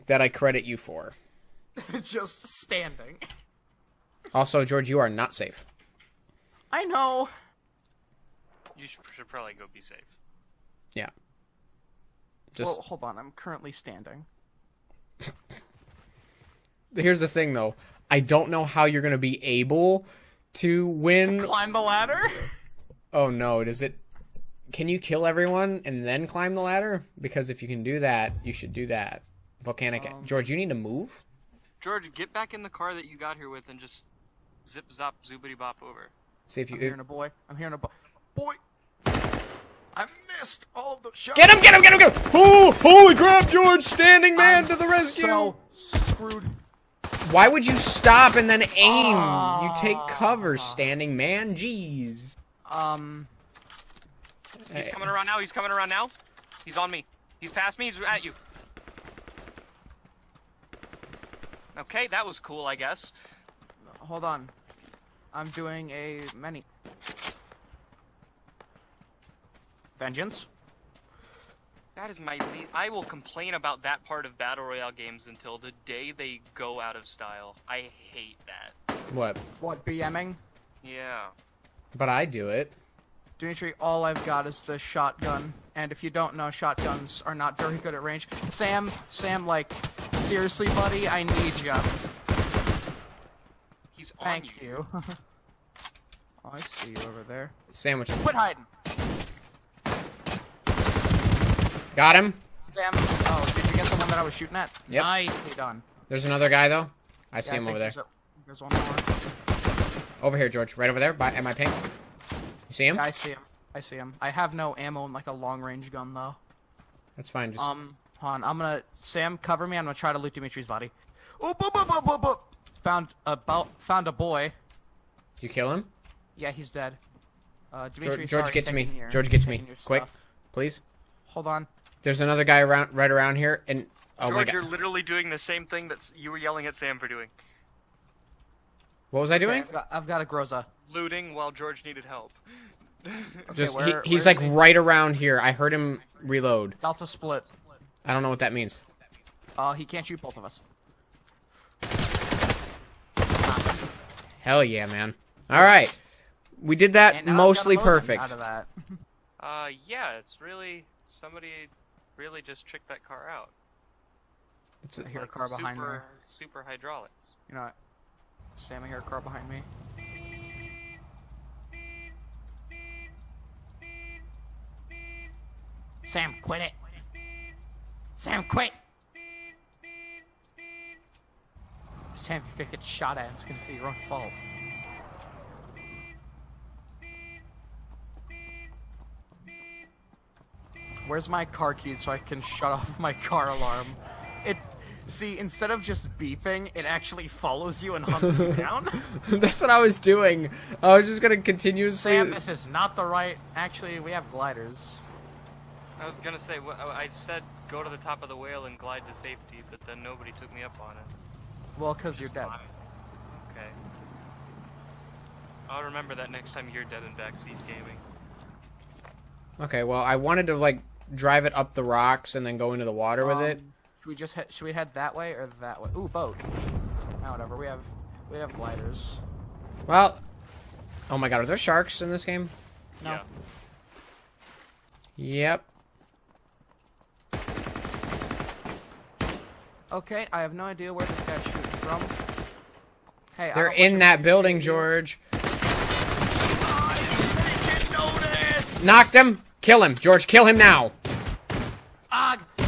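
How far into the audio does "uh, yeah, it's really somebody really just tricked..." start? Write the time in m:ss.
2:39.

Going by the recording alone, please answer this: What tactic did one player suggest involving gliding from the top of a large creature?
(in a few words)
Go to the top of the whale.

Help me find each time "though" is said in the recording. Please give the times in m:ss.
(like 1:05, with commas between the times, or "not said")
0:17, 1:46, 1:56.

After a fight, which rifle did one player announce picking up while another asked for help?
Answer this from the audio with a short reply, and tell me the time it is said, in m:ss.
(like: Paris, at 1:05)
Groza, at 2:20.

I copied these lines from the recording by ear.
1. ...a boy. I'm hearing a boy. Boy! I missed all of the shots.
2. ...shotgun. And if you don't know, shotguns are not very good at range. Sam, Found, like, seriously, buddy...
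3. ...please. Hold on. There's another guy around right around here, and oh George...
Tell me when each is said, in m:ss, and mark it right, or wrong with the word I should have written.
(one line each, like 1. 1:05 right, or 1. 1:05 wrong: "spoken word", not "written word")
1. 0:36 right
2. 1:24 wrong: "Sam", not "Found"
3. 2:10 right.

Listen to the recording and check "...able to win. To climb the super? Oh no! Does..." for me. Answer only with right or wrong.
wrong.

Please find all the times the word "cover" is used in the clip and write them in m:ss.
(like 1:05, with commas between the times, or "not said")
0:50, 1:59.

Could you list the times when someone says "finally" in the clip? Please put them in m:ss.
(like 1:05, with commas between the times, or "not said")
not said.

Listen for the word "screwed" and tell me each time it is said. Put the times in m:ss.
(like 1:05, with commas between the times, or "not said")
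0:45.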